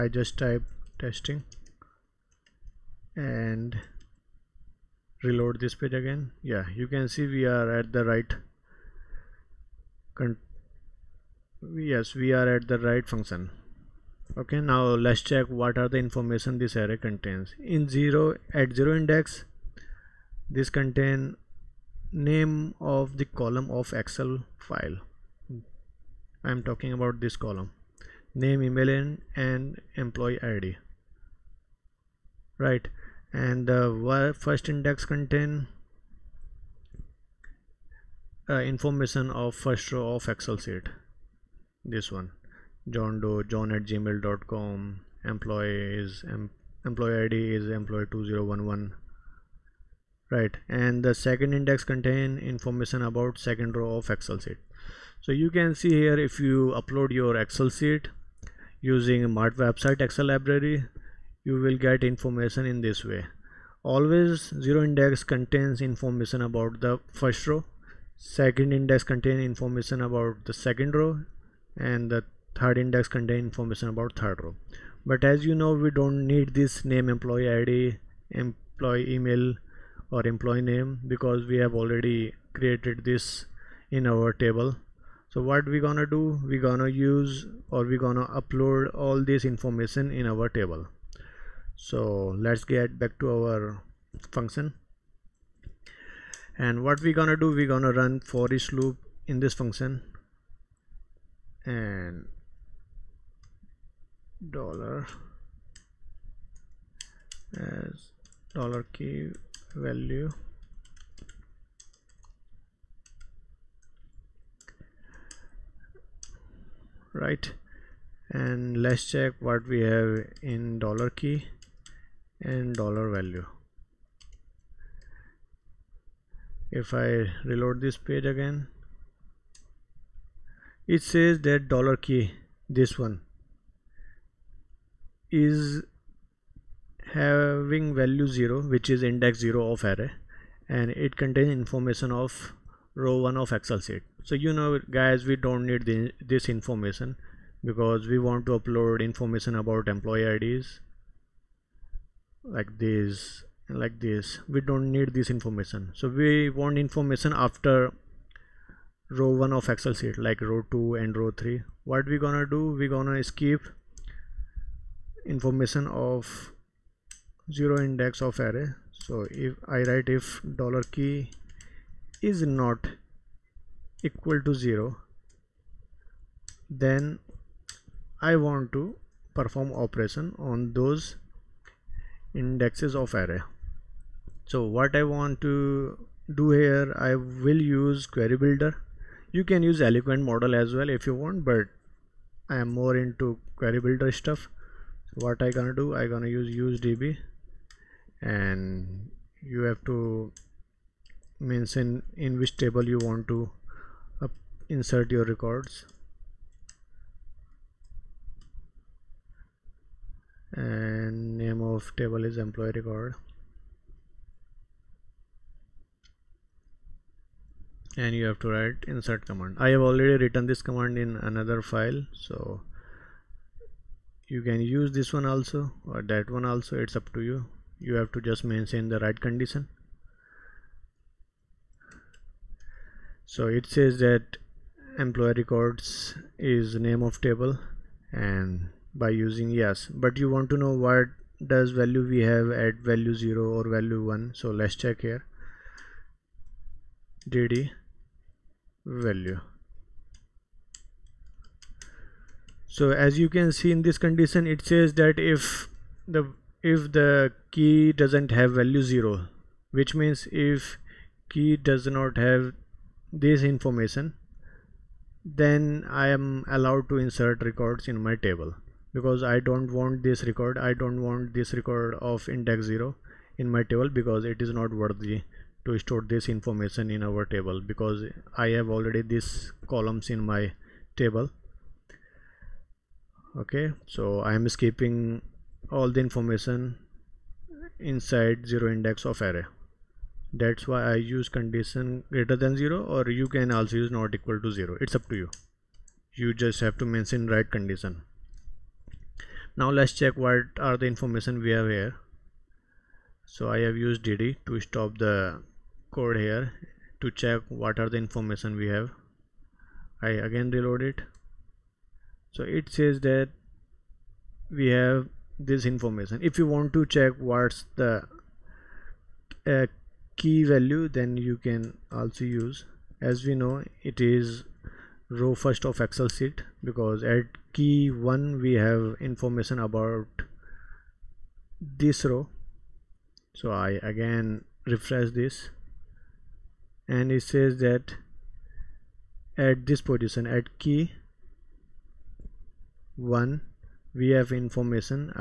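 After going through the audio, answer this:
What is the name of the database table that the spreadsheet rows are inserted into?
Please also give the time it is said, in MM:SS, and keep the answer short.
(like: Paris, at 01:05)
employee record, at 03:32.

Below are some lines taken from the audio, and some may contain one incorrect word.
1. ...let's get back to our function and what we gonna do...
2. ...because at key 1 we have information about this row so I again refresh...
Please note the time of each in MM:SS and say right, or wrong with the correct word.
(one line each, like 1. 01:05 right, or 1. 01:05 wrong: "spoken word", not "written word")
1. 01:32 right
2. 05:26 right.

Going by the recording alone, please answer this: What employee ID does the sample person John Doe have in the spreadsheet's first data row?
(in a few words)
employee 2011.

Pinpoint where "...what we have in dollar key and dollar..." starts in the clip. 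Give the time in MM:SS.
01:59.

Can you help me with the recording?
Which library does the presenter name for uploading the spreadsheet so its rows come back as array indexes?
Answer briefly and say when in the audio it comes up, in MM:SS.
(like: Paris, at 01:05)
Maatwebsite Excel, at 00:59.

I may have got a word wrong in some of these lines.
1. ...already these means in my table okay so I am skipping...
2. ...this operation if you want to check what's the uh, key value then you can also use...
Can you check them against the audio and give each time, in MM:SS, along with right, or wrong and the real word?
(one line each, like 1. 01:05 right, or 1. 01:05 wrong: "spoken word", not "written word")
1. 04:38 wrong: "columns", not "means"
2. 05:15 wrong: "information", not "operation".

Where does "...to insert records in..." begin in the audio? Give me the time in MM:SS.
04:26.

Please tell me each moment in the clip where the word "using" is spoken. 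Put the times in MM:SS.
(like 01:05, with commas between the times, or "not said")
00:58, 03:59.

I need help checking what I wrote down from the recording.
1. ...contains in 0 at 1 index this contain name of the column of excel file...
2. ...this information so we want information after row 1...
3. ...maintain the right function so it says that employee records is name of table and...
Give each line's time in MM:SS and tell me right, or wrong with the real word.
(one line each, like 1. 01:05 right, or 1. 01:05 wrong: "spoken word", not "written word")
1. 00:16 wrong: "0", not "1"
2. 02:35 right
3. 03:48 wrong: "condition", not "function".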